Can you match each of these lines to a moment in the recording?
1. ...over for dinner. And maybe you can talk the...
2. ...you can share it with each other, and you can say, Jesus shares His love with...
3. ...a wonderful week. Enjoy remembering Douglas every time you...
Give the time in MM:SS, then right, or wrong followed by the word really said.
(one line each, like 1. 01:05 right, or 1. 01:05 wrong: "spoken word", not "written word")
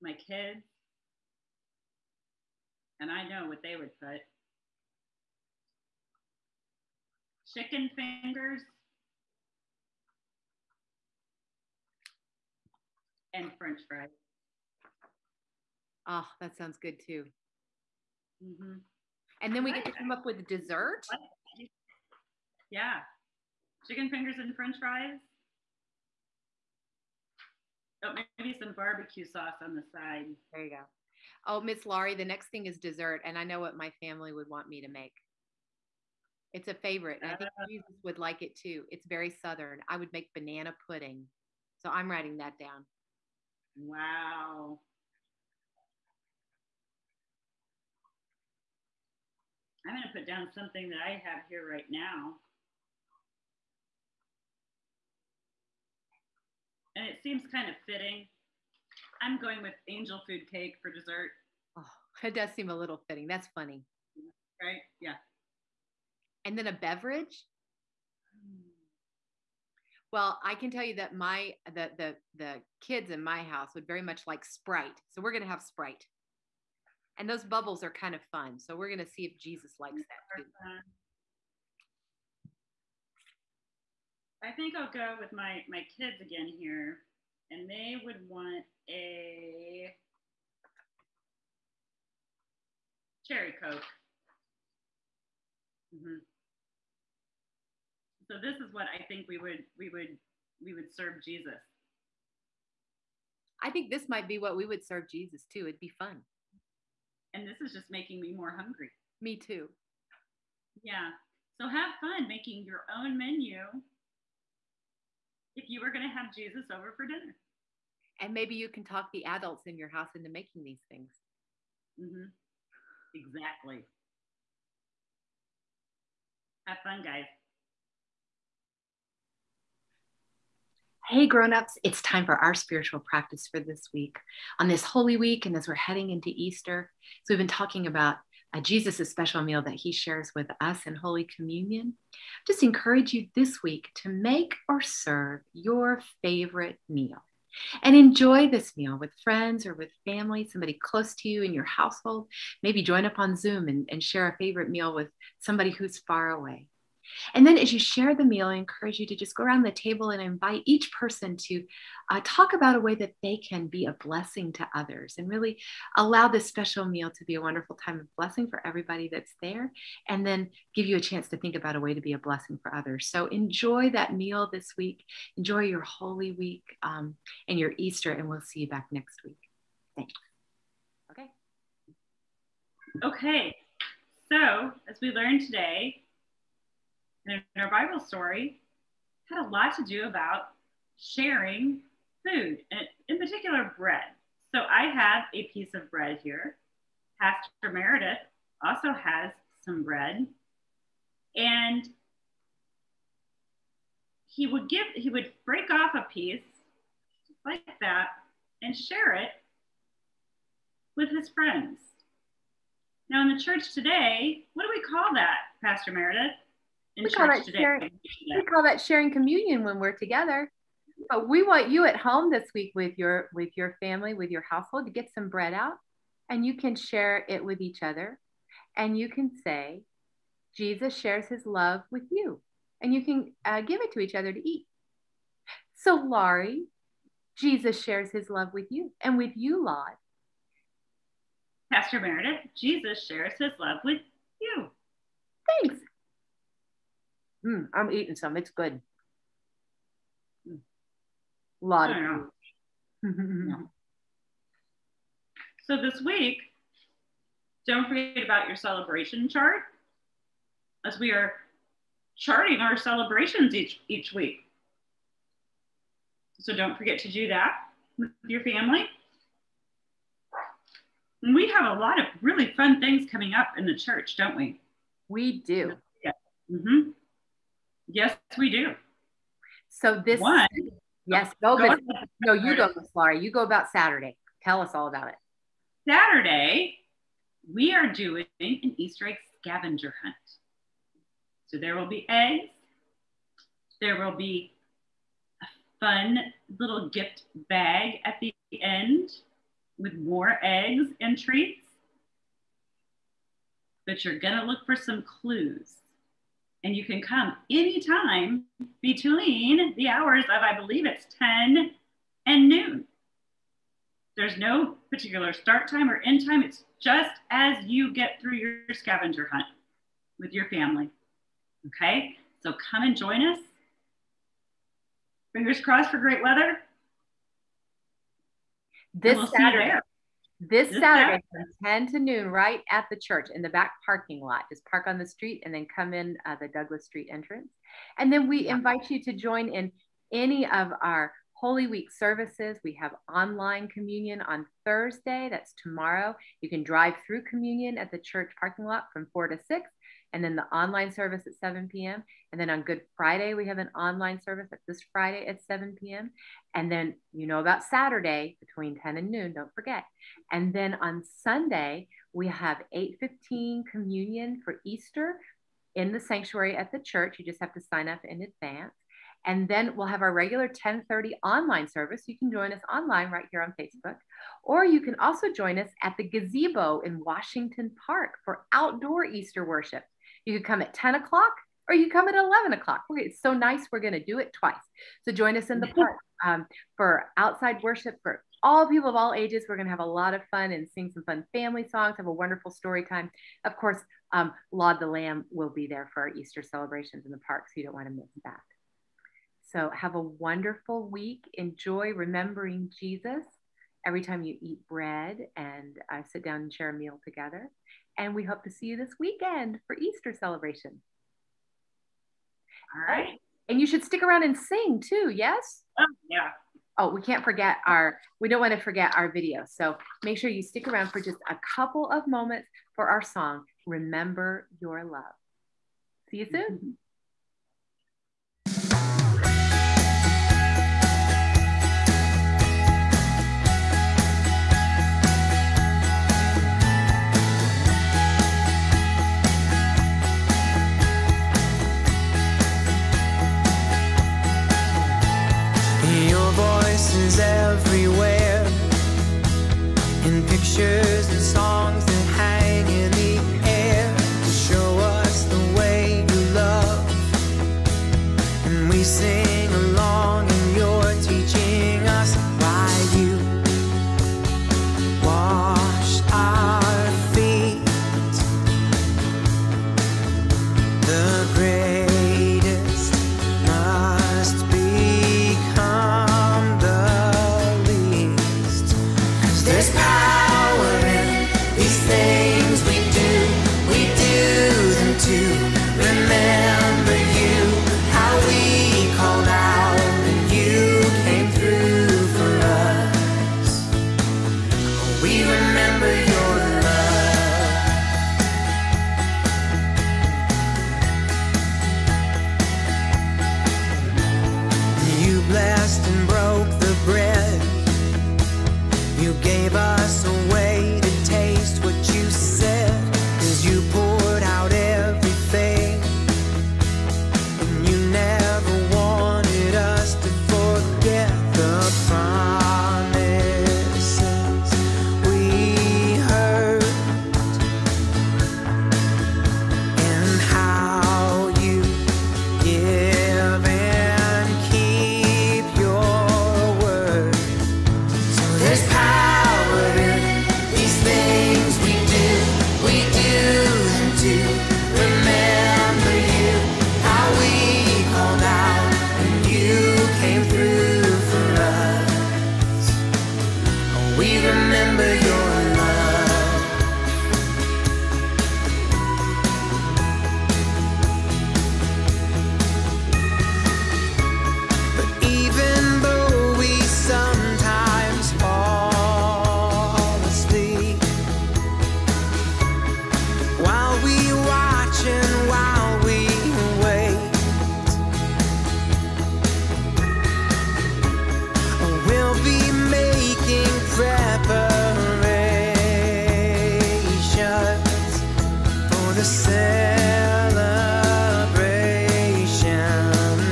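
1. 01:56 right
2. 03:46 right
3. 06:39 wrong: "Jesus", not "Douglas".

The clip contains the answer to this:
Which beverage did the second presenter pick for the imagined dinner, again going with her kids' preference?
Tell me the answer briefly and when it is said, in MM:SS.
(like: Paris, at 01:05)
cherry Coke, at 01:33.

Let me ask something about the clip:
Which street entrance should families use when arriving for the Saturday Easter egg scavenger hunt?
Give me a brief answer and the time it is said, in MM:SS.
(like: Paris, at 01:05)
Douglas Street, at 05:36.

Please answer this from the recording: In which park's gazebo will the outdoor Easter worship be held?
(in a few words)
Washington Park.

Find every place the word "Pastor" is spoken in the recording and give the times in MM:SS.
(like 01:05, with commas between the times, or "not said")
03:17, 03:35, 04:01.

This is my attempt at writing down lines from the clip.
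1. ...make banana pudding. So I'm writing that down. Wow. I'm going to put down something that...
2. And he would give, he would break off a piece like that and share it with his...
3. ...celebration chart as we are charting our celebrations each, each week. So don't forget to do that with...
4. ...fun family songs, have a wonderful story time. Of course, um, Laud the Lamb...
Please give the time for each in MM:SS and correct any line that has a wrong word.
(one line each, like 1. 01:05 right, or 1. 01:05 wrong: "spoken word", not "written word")
1. 00:40 right
2. 03:21 right
3. 04:18 right
4. 06:31 right.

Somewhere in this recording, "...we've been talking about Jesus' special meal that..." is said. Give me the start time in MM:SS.
02:17.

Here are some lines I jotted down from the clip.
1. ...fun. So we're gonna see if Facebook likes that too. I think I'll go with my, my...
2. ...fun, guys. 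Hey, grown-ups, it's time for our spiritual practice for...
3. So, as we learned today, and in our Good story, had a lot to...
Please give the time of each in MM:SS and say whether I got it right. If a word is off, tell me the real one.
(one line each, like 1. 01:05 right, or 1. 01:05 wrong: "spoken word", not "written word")
1. 01:18 wrong: "Jesus", not "Facebook"
2. 02:06 right
3. 03:04 wrong: "Bible", not "Good".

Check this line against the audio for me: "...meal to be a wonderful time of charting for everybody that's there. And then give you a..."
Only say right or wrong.
wrong.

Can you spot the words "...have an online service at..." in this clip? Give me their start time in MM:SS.
05:53.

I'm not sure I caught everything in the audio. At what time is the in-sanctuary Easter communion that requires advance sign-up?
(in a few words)
8:15.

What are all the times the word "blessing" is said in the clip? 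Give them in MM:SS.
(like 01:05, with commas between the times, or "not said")
02:44, 02:48, 02:52.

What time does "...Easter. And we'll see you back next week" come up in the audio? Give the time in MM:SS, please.
02:57.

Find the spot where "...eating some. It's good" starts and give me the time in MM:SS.
04:07.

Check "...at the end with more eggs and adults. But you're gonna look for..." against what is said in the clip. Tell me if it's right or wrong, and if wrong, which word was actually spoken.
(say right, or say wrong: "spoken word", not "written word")
wrong: "treats", not "adults".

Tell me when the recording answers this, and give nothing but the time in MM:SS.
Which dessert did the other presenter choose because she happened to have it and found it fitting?
00:59.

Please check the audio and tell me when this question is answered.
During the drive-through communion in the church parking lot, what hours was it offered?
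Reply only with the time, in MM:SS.
05:49.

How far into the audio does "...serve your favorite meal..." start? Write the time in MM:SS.
02:24.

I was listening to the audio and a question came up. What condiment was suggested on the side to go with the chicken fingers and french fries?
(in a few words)
barbecue sauce.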